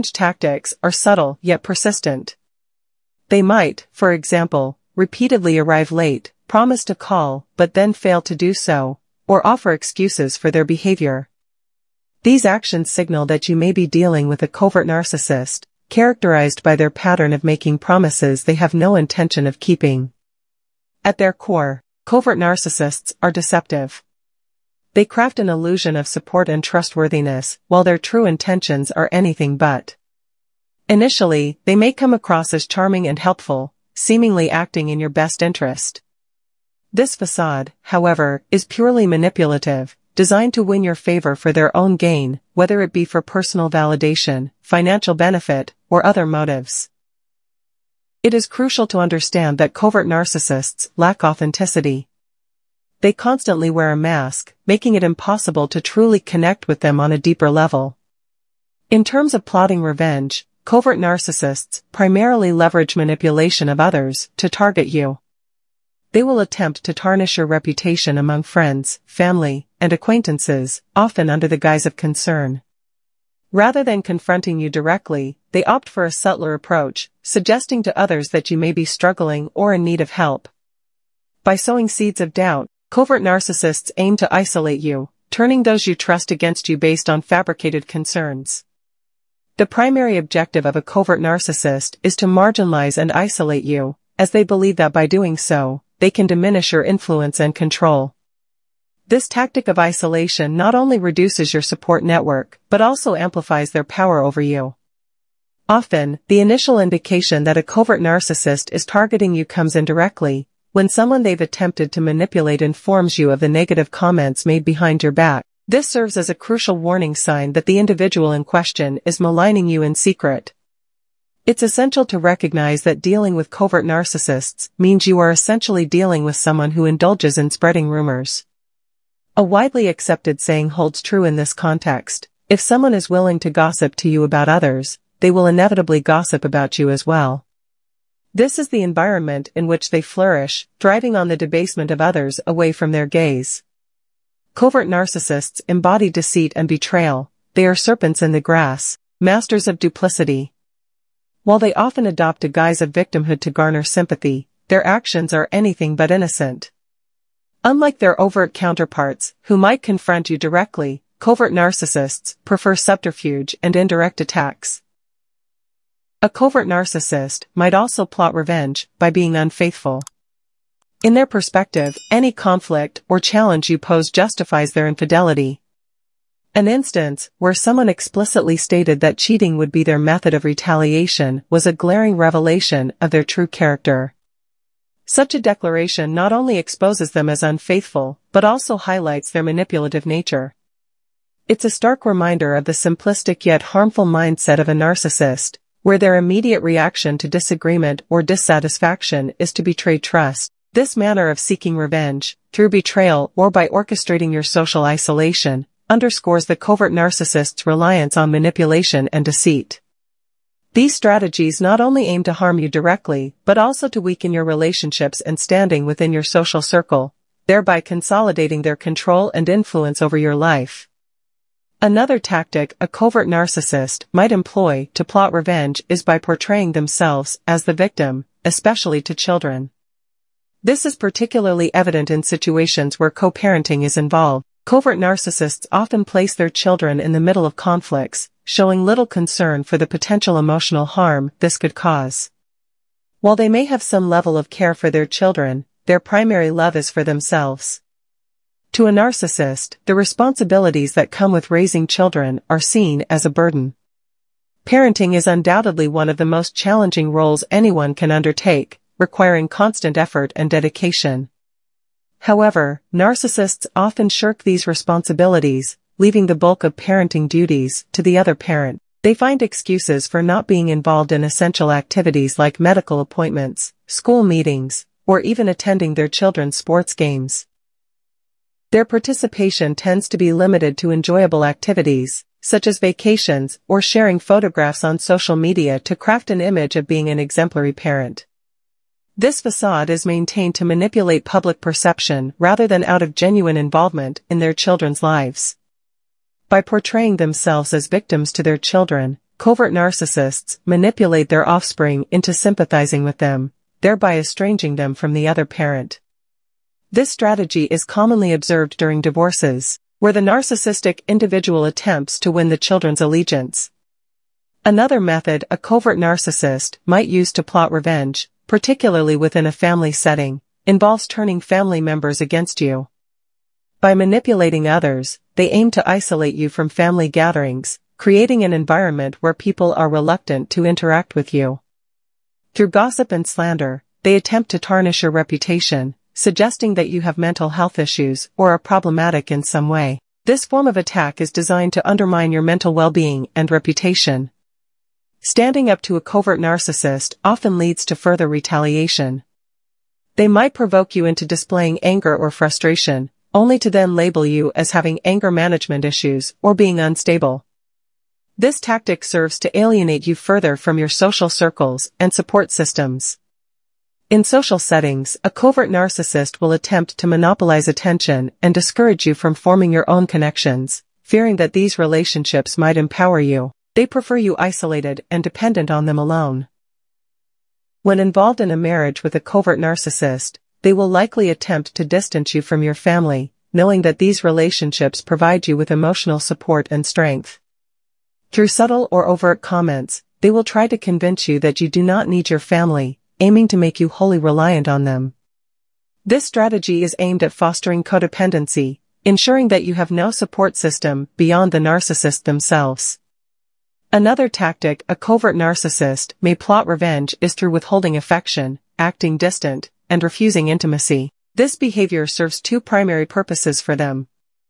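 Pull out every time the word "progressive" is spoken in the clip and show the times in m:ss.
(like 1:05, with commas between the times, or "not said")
not said.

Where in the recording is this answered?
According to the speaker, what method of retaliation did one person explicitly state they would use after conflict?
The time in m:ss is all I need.
2:59.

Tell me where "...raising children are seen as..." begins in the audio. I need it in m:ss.
4:11.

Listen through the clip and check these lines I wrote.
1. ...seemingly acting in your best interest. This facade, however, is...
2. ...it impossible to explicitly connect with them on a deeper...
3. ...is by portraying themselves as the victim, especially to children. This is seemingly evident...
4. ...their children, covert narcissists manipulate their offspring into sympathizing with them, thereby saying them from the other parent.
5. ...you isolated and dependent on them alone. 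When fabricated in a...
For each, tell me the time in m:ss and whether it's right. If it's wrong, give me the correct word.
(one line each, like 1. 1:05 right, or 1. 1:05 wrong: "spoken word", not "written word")
1. 0:33 right
2. 0:54 wrong: "truly", not "explicitly"
3. 3:45 wrong: "particularly", not "seemingly"
4. 4:58 wrong: "estranging", not "saying"
5. 6:14 wrong: "involved", not "fabricated".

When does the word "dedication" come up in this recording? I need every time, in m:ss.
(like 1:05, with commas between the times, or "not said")
4:20.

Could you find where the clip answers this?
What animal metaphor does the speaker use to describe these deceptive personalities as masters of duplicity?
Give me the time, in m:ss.
2:27.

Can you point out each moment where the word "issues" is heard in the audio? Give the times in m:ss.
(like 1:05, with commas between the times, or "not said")
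5:37, 5:55.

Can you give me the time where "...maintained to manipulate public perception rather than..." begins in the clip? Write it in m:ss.
4:50.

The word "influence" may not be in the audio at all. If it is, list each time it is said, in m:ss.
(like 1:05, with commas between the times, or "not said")
1:36, 3:39.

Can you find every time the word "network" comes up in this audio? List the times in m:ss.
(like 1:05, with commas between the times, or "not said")
1:42.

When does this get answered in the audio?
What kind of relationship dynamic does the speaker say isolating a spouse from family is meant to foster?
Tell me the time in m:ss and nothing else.
6:37.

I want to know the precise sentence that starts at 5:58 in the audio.
This tactic serves to alienate you further from your social circles and support systems.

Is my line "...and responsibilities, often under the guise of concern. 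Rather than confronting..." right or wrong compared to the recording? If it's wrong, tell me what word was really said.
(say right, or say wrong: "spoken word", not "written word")
wrong: "acquaintances", not "responsibilities".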